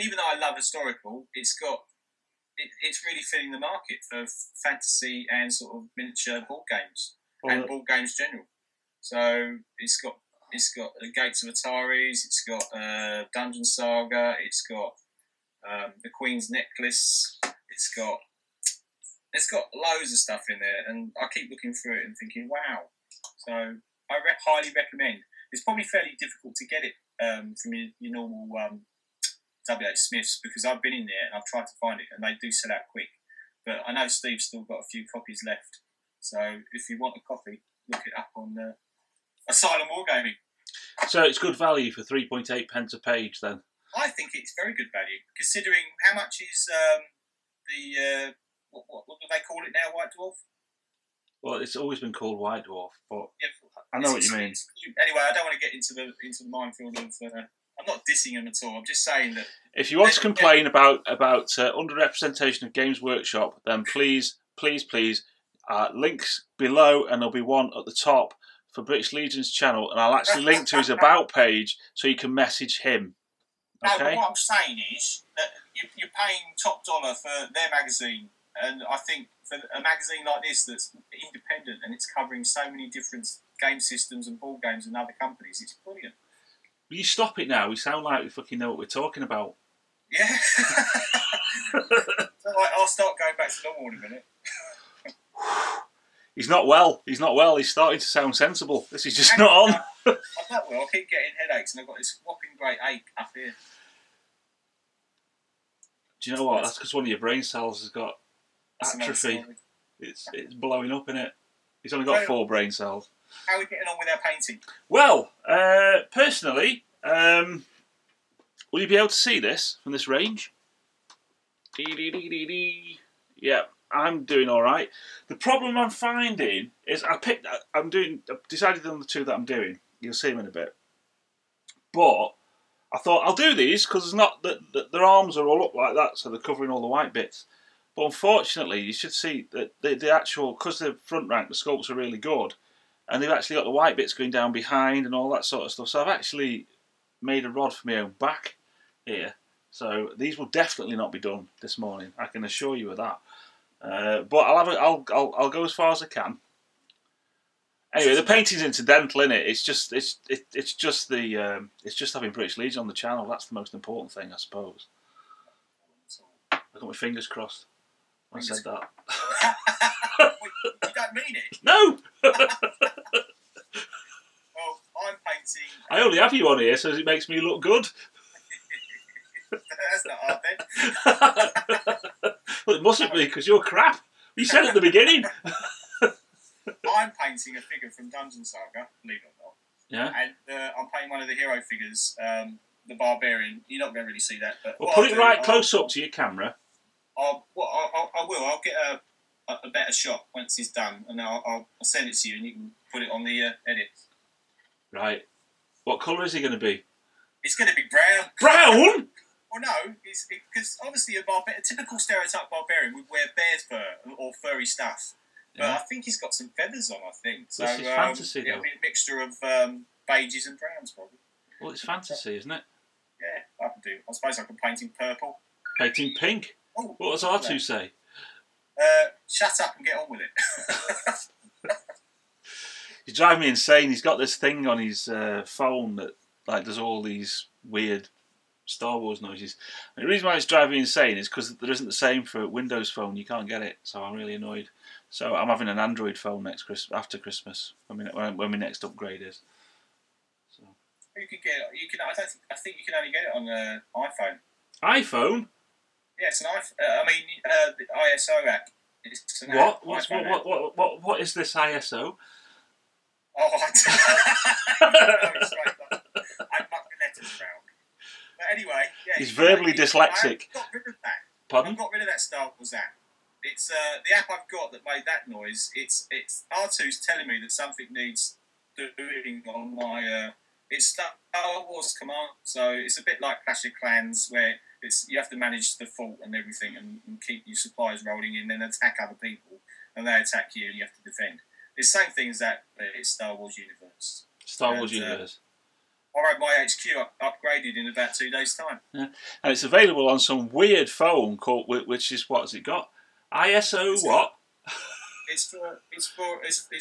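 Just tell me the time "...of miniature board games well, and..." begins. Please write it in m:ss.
0:05.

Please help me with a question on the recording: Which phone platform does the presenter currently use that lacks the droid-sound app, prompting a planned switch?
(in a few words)
Windows Phone.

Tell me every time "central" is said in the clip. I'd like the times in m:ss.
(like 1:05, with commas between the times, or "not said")
not said.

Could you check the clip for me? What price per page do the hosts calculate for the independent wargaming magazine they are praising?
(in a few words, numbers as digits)
3.8 pence.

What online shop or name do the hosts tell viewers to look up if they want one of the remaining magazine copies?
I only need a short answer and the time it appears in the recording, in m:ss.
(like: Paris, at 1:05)
Asylum Wargaming, at 0:39.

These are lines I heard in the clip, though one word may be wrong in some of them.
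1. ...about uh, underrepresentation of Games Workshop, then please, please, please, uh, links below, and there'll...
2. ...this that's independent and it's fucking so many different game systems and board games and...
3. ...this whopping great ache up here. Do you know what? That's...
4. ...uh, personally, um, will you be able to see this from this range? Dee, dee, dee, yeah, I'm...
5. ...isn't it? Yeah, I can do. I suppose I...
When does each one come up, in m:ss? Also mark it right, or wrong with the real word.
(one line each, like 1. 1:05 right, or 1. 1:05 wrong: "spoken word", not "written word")
1. 1:01 right
2. 1:20 wrong: "covering", not "fucking"
3. 1:41 right
4. 1:55 right
5. 3:42 right.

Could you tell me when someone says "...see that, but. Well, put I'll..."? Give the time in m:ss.
3:14.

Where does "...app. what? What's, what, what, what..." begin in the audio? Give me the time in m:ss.
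4:18.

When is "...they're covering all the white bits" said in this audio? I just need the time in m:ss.
2:16.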